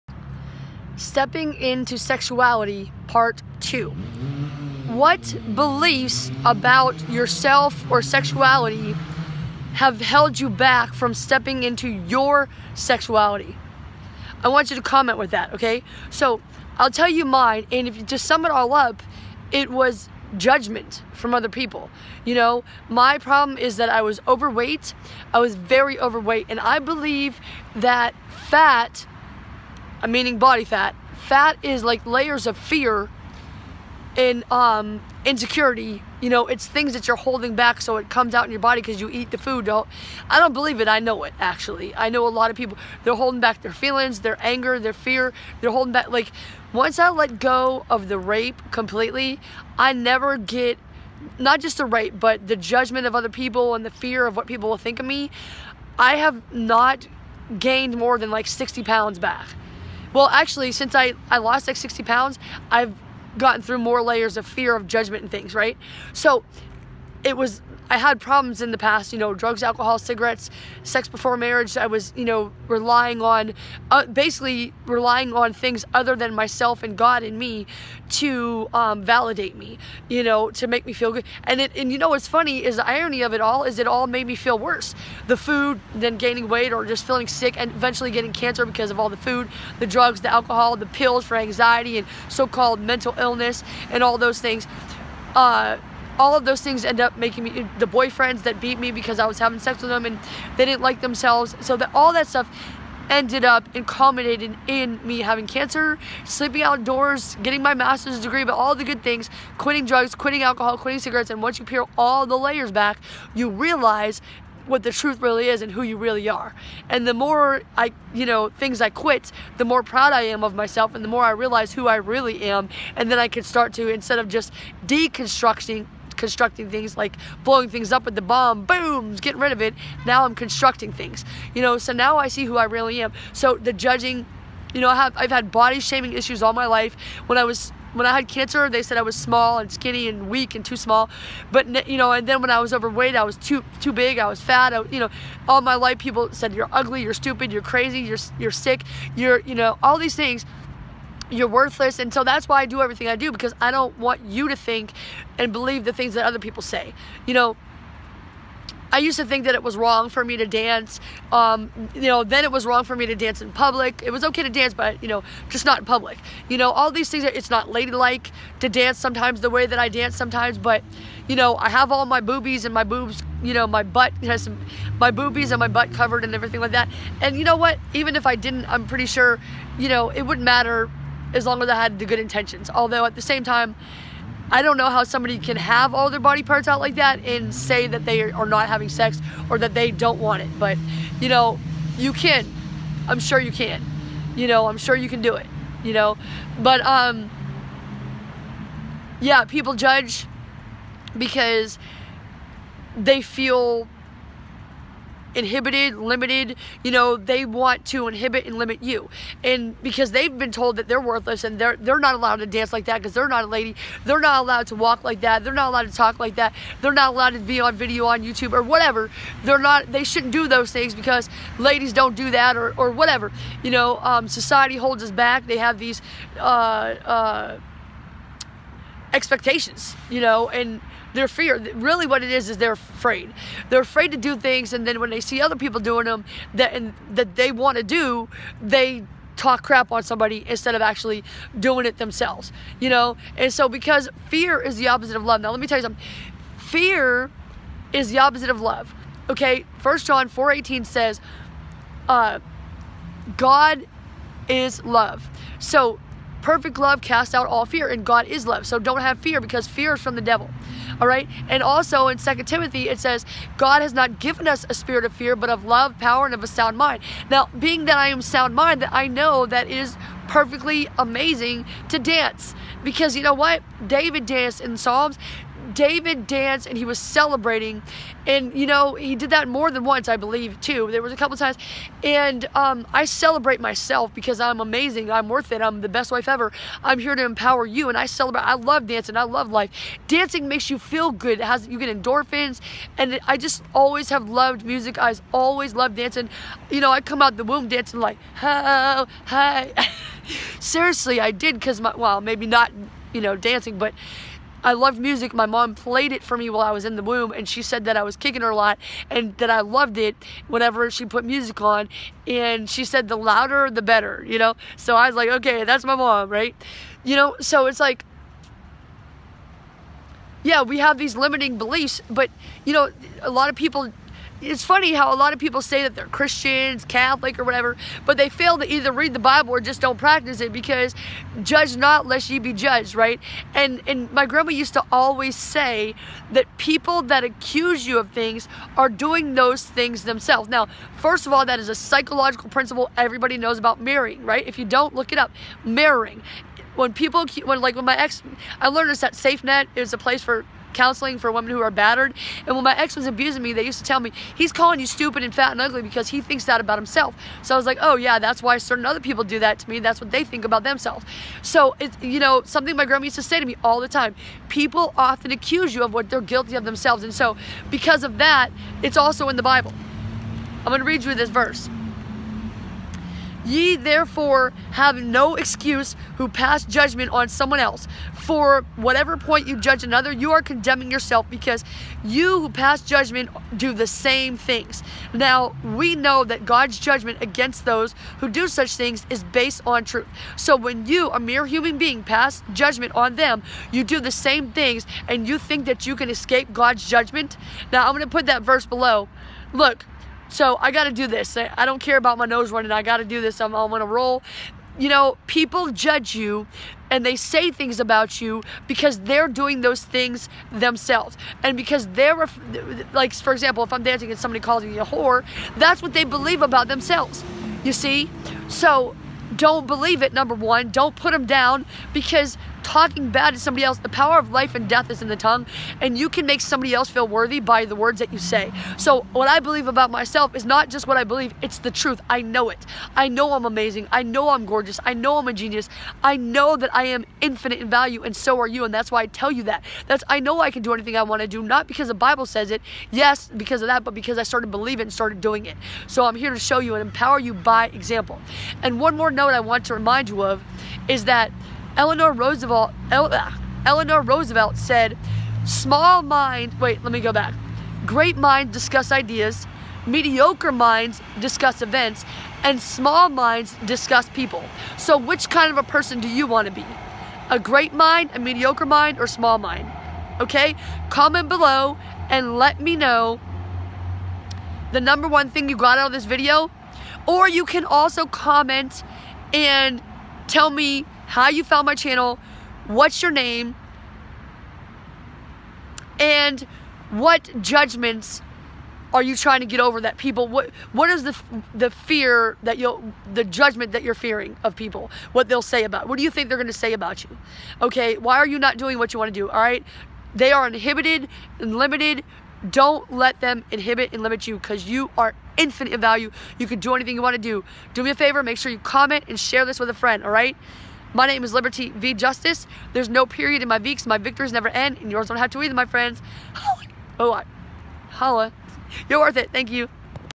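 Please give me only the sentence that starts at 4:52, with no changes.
And I just always have loved music.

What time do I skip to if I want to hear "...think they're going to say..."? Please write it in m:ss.
8:16.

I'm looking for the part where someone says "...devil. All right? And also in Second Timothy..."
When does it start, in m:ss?
4:20.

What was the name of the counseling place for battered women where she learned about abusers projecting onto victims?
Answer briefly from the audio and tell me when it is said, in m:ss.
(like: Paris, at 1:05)
SafeNet, at 5:49.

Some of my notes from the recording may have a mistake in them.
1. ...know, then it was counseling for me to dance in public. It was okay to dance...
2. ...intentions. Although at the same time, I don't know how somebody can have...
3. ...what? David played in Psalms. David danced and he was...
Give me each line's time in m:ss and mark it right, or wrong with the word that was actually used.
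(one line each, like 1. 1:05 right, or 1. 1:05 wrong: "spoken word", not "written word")
1. 2:42 wrong: "wrong", not "counseling"
2. 3:02 right
3. 4:33 wrong: "danced", not "played".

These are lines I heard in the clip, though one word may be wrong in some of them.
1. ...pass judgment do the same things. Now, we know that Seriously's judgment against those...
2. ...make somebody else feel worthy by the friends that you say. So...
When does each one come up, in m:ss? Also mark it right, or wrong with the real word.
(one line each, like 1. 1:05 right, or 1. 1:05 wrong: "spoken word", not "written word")
1. 6:22 wrong: "God", not "Seriously"
2. 7:06 wrong: "words", not "friends".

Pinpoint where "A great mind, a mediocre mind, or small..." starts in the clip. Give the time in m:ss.
7:47.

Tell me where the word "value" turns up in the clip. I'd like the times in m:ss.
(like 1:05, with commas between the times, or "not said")
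7:17, 8:25.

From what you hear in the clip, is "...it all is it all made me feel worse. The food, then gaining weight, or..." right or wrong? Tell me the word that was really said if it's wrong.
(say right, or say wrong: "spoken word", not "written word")
right.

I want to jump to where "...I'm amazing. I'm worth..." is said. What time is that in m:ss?
4:44.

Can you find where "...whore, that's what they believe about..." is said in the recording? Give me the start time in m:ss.
6:54.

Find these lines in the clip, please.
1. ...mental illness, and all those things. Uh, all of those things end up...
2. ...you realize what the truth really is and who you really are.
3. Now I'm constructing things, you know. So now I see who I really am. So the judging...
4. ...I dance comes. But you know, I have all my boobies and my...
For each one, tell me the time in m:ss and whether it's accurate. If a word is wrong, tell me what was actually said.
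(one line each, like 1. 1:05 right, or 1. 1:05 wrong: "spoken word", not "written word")
1. 1:32 right
2. 1:53 right
3. 2:10 right
4. 2:49 wrong: "sometimes", not "comes".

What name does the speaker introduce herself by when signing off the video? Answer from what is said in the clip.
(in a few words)
Liberty V Justice.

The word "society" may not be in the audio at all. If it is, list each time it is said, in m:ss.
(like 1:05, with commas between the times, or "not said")
3:44.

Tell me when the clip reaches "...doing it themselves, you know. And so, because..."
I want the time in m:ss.
4:01.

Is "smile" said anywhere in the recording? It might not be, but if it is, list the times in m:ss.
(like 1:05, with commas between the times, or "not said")
not said.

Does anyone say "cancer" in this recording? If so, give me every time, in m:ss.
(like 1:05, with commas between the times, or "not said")
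1:28, 1:45, 2:18.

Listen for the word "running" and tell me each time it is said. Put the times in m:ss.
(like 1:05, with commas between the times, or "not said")
6:42.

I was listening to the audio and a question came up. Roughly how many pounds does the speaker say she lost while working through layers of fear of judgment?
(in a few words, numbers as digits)
60.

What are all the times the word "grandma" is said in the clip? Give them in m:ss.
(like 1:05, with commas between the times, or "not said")
5:34, 6:02.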